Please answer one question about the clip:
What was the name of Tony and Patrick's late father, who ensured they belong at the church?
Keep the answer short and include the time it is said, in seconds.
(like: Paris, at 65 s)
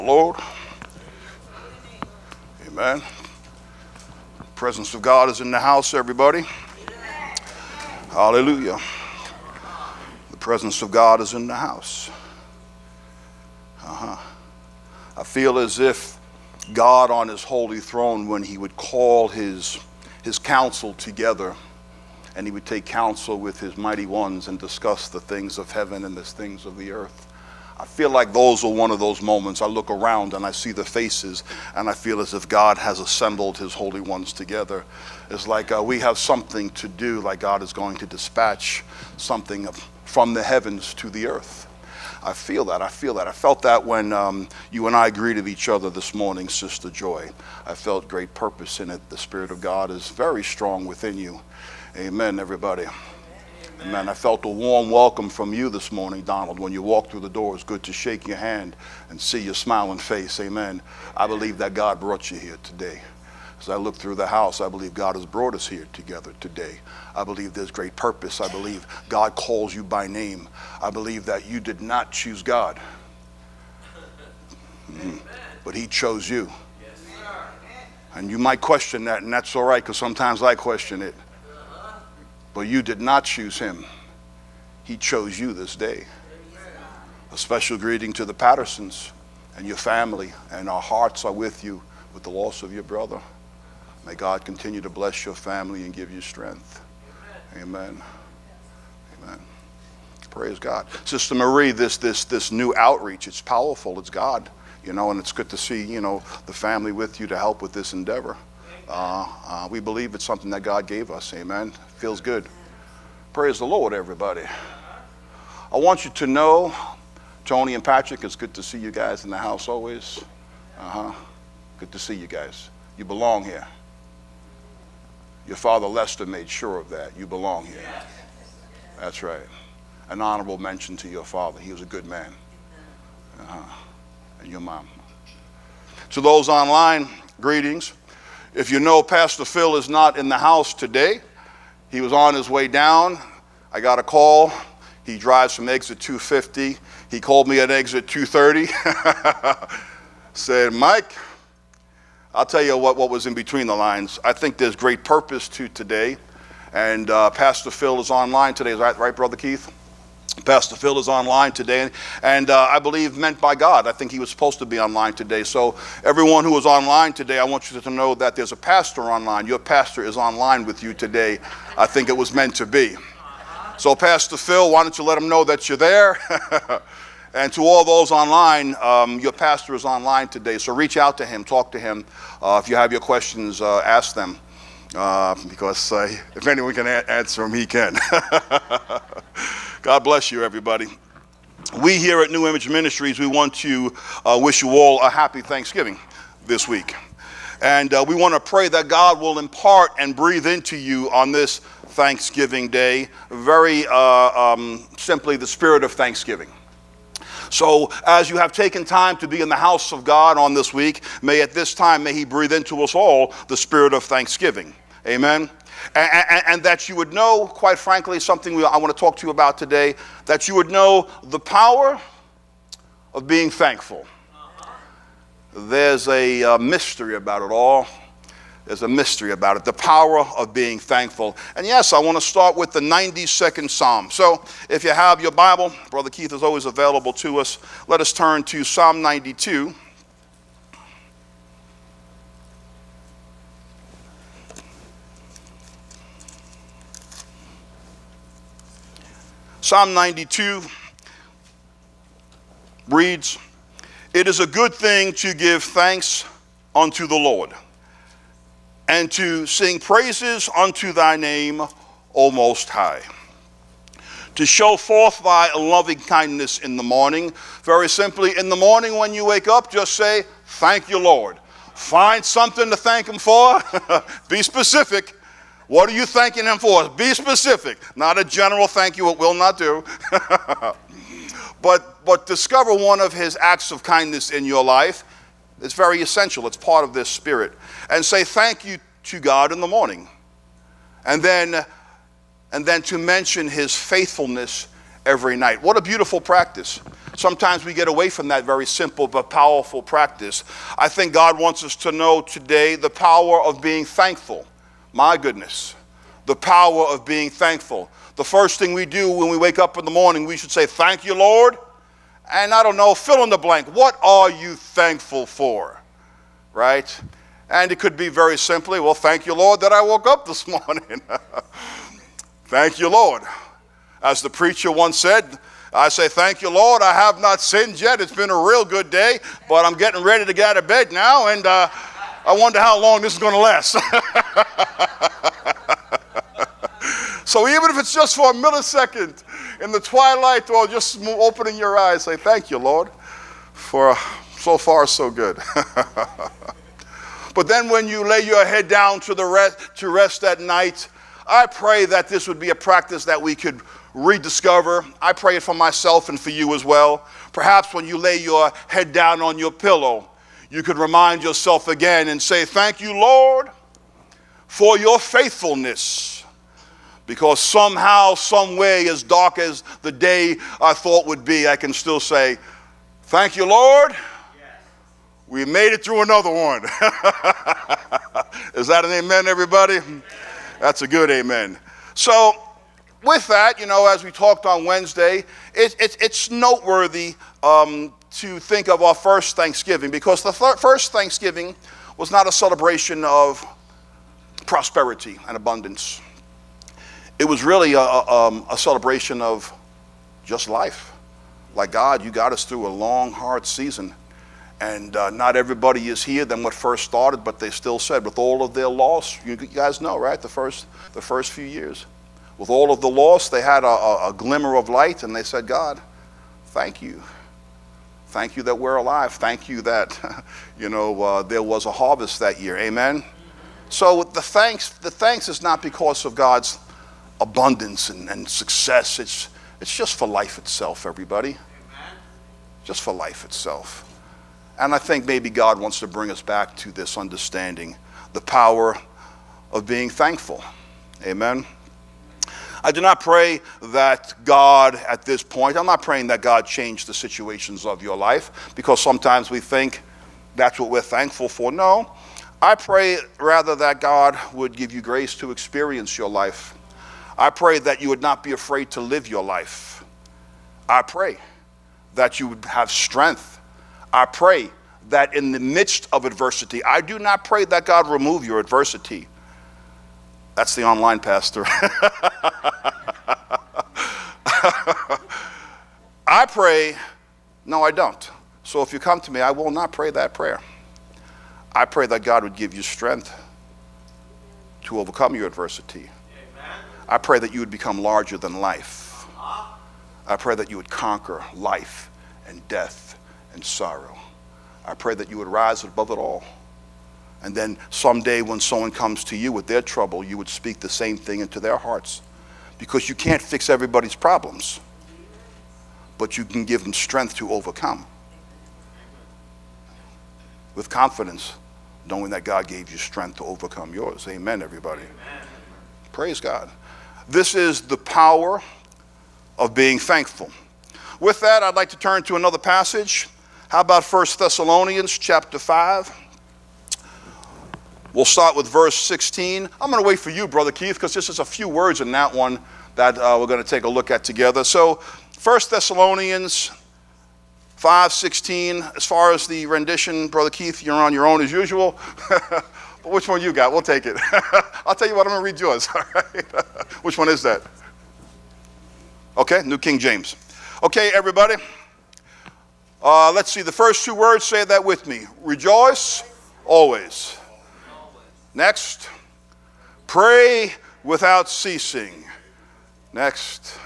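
Lester, at 125 s.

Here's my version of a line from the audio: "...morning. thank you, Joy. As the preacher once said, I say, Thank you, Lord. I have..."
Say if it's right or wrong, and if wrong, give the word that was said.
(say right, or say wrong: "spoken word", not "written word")
wrong: "Lord", not "Joy".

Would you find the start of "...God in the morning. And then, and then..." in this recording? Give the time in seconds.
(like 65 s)
289 s.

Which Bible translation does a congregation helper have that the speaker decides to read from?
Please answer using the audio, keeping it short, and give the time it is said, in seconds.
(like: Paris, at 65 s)
New King James, at 549 s.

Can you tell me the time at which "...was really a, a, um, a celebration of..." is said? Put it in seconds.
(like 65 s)
397 s.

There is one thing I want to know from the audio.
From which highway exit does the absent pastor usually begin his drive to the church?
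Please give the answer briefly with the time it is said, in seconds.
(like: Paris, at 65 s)
Exit 250, at 145 s.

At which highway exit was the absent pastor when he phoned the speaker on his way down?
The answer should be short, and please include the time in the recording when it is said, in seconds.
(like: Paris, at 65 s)
Exit 230, at 147 s.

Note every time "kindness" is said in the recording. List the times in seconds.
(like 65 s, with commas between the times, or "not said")
266 s, 283 s.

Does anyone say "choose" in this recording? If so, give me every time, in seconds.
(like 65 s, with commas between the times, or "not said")
72 s, 83 s.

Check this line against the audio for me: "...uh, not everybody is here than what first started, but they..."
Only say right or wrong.
right.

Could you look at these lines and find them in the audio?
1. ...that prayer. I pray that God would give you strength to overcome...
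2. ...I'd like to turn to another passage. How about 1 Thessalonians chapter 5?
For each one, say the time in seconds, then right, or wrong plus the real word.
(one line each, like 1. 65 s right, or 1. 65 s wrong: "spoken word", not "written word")
1. 479 s right
2. 521 s right.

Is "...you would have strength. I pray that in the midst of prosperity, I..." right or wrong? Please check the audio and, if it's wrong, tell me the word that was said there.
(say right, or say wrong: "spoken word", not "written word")
wrong: "adversity", not "prosperity".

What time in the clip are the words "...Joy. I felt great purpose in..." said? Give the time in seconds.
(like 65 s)
46 s.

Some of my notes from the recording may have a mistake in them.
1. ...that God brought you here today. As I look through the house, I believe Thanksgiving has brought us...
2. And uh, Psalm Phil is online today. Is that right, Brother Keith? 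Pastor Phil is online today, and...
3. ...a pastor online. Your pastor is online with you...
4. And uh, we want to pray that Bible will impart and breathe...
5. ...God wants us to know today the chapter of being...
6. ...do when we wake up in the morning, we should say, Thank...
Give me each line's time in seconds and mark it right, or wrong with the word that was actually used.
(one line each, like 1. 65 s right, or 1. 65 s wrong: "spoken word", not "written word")
1. 61 s wrong: "God", not "Thanksgiving"
2. 156 s wrong: "Pastor", not "Psalm"
3. 168 s right
4. 197 s wrong: "God", not "Bible"
5. 301 s wrong: "power", not "chapter"
6. 308 s right.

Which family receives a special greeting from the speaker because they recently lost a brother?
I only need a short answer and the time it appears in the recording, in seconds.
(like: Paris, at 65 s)
The Pattersons, at 88 s.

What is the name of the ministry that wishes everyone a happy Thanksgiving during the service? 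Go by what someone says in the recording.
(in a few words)
New Image Ministries.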